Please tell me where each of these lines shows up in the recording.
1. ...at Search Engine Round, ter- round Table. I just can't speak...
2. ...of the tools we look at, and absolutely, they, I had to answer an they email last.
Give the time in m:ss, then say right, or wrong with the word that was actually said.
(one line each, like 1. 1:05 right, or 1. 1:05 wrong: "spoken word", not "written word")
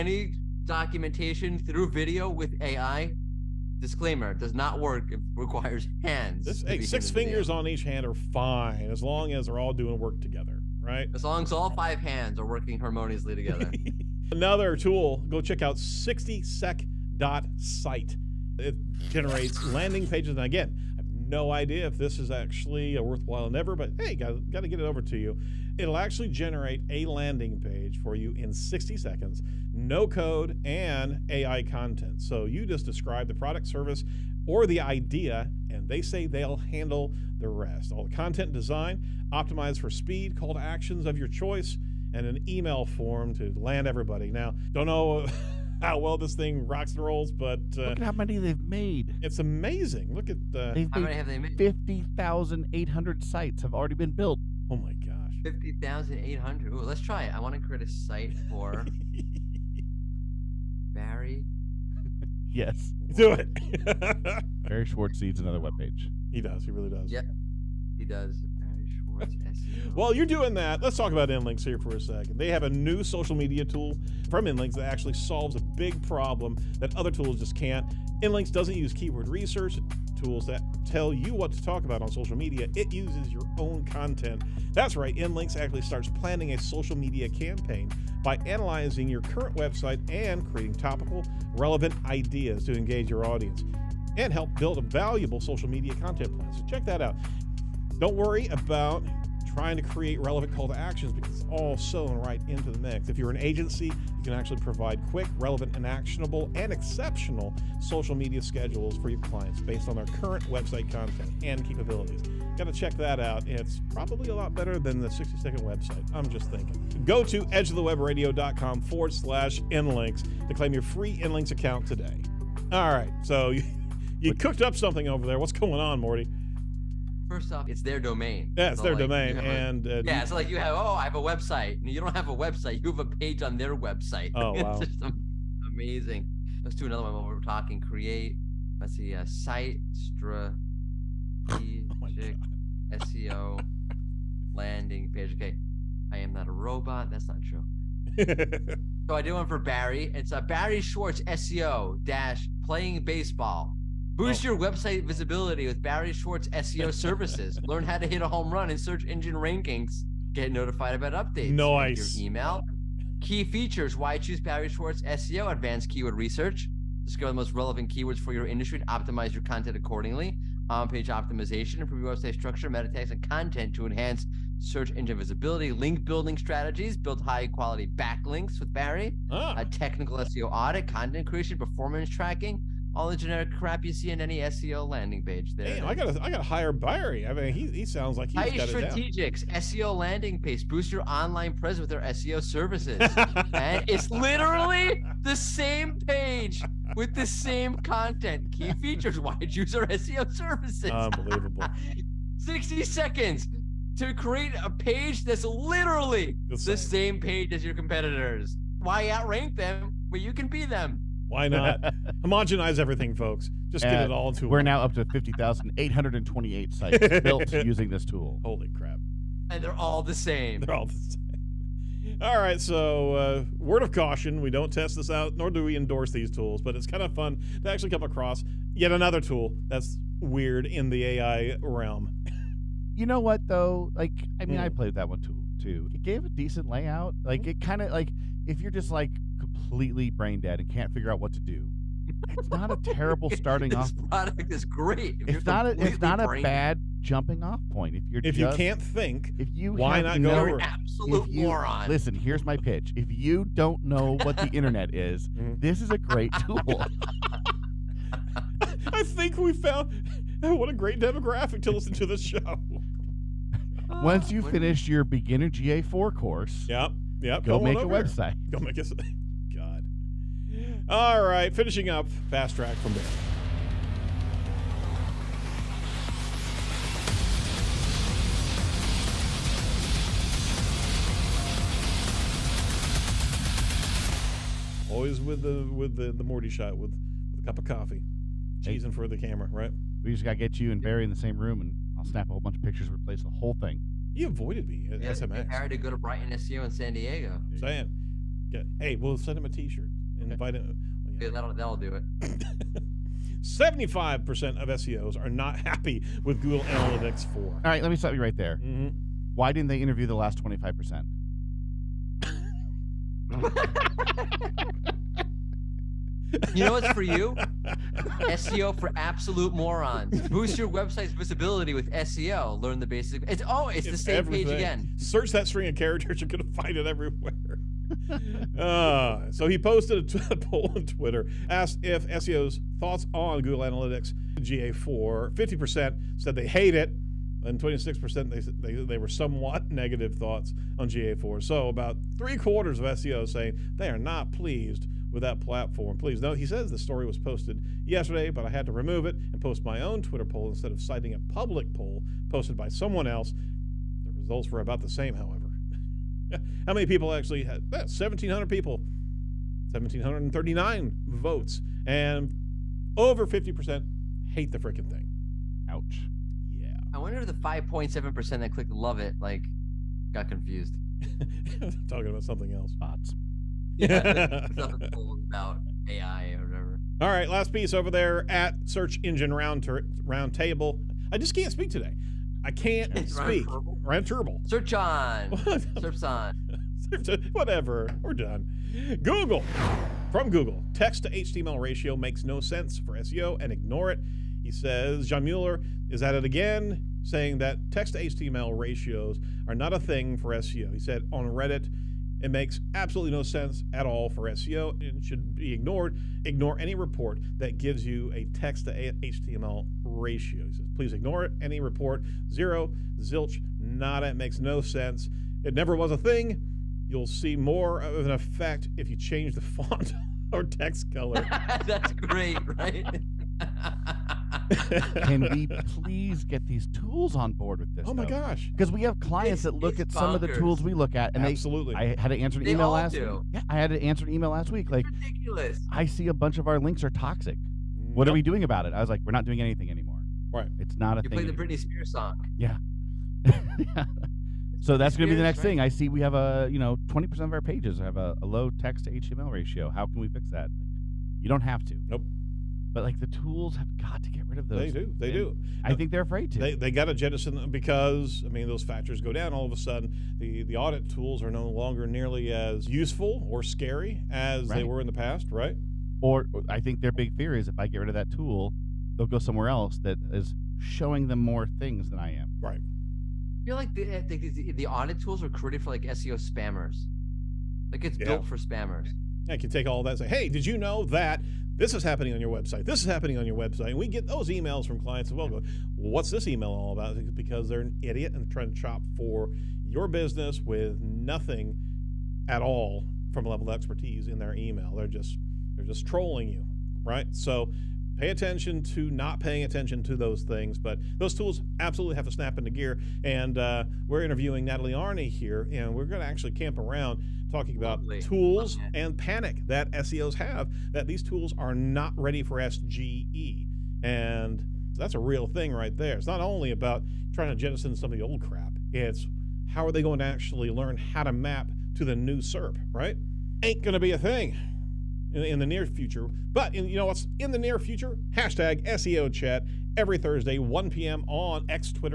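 1. 6:18 right
2. 7:10 right.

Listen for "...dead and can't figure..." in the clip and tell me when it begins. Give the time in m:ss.
4:00.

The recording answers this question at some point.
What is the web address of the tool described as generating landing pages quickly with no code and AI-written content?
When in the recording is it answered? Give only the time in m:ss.
0:15.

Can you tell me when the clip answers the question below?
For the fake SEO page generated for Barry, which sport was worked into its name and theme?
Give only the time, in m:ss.
2:33.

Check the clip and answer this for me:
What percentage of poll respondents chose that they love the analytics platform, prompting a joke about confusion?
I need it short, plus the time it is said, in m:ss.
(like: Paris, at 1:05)
5.7%, at 6:07.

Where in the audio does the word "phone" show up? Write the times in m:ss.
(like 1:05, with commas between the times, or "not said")
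not said.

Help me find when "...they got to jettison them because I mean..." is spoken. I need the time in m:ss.
7:36.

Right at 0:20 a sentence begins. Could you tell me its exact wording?
And again, I have no idea if this is actually a worthwhile endeavor, but hey, got to get it over to you.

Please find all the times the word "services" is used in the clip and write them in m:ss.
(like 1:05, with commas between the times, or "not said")
0:33, 2:36, 3:12, 3:20.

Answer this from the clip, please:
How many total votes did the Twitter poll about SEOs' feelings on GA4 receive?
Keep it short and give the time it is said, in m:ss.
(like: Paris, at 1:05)
1,739, at 5:59.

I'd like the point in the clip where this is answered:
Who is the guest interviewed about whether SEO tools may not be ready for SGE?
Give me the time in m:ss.
8:24.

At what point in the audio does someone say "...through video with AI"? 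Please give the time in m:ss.
0:01.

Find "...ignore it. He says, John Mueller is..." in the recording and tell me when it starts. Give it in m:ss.
6:33.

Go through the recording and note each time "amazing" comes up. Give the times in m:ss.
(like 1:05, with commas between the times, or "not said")
0:49, 2:15.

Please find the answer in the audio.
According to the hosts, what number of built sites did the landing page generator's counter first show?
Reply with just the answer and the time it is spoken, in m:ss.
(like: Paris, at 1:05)
50,800, at 0:55.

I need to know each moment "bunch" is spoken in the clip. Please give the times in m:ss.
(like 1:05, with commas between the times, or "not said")
4:52, 7:16.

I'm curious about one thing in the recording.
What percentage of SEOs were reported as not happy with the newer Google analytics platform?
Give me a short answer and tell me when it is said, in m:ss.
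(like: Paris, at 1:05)
75%, at 5:03.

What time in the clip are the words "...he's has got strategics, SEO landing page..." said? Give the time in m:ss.
3:08.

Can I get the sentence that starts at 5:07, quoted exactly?
All right, let me stop you right there.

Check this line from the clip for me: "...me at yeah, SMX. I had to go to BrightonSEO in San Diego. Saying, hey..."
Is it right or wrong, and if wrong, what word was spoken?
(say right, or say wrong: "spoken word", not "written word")
right.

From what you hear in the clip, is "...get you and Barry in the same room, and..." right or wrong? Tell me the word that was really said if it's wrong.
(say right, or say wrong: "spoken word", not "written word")
right.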